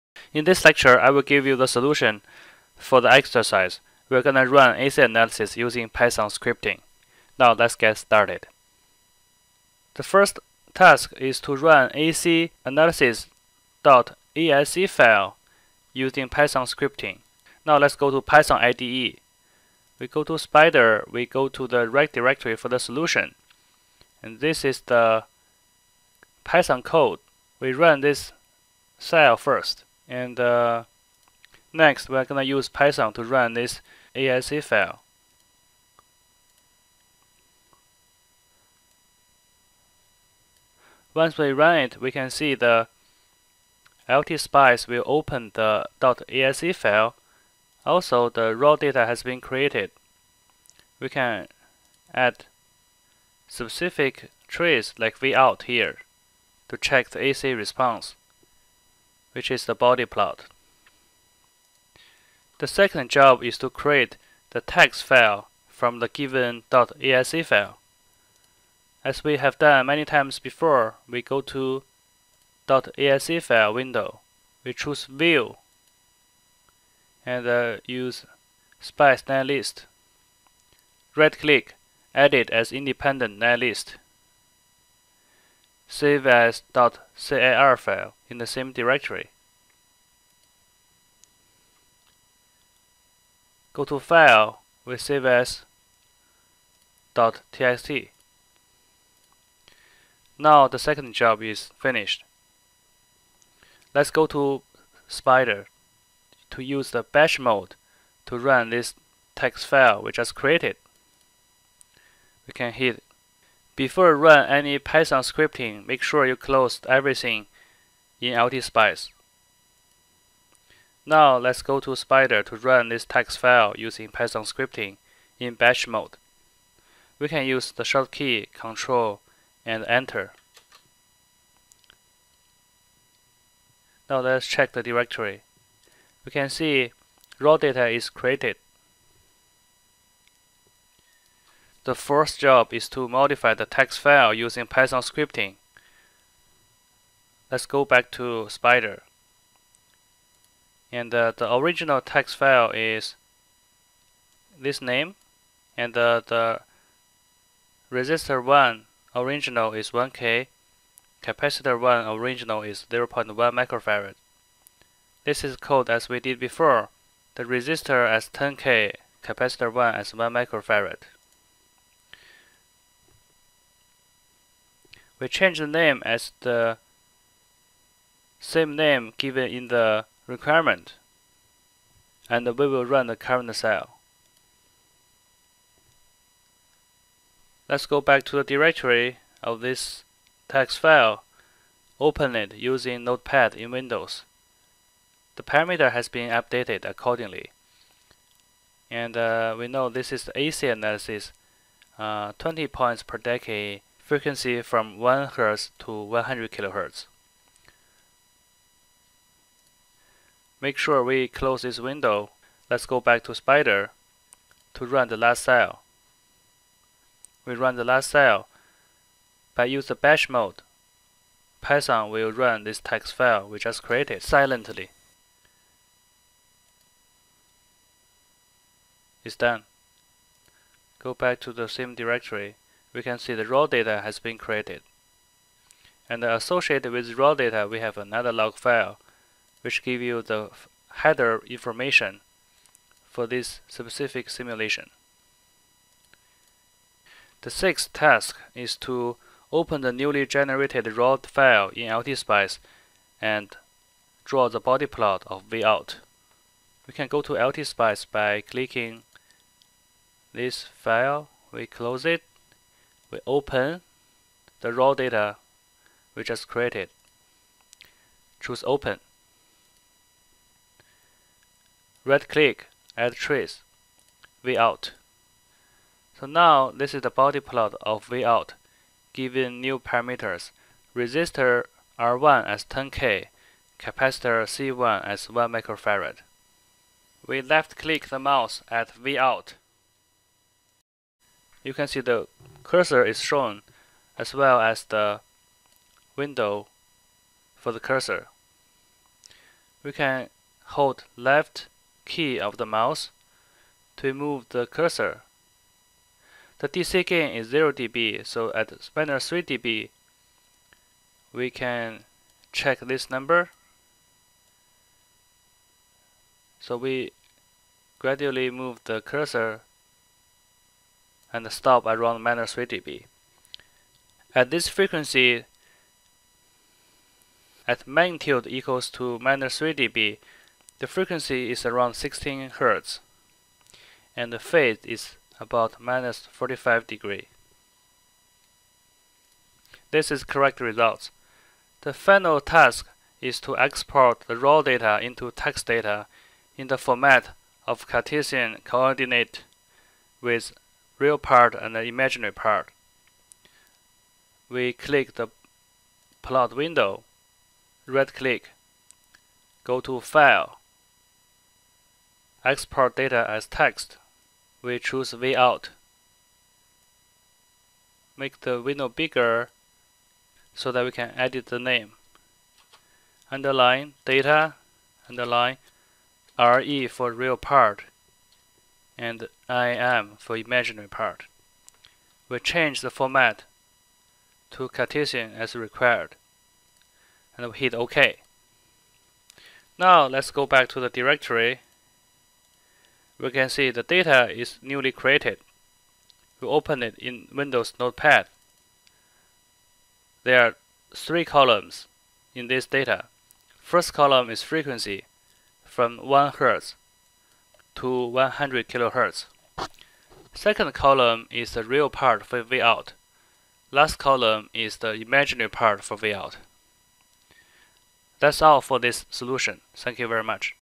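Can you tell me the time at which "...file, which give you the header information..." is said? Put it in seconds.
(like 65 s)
238 s.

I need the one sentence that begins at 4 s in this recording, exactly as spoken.
We're going to run AC analysis using Python scripting.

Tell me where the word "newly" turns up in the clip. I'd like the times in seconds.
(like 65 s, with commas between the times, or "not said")
249 s, 394 s.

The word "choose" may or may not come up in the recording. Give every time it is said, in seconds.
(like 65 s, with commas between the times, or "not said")
74 s, 268 s, 364 s.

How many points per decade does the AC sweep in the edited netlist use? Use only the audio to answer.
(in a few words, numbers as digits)
20.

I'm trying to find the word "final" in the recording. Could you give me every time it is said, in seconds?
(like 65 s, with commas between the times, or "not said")
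341 s.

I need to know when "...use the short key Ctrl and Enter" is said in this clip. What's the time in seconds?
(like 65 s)
127 s.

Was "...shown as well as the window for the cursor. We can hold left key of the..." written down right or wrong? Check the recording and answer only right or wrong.
right.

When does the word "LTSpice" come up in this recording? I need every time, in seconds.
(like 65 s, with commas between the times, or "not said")
44 s, 118 s, 251 s, 257 s.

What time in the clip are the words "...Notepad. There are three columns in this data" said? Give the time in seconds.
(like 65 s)
397 s.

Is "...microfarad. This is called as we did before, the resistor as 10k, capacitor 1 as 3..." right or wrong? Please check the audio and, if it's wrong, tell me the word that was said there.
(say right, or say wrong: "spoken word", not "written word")
wrong: "1", not "3".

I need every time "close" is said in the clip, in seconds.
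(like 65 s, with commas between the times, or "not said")
116 s, 211 s, 261 s.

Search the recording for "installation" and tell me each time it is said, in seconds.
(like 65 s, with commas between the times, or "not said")
not said.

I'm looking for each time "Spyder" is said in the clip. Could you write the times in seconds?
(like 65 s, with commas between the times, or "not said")
20 s, 105 s, 121 s, 148 s, 213 s.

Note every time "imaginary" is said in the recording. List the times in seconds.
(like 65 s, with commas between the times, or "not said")
351 s, 380 s, 414 s.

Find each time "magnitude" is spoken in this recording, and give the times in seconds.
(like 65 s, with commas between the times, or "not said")
327 s.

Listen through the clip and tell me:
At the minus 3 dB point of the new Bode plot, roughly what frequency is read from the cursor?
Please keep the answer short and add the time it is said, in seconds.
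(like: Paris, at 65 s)
16 Hz, at 331 s.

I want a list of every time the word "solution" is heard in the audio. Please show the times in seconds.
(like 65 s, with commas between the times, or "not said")
1 s, 22 s, 419 s.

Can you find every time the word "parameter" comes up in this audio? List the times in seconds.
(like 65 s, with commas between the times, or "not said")
195 s, 279 s.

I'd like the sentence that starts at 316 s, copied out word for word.
So we gradually move the cursor and stop around minus 3 dB.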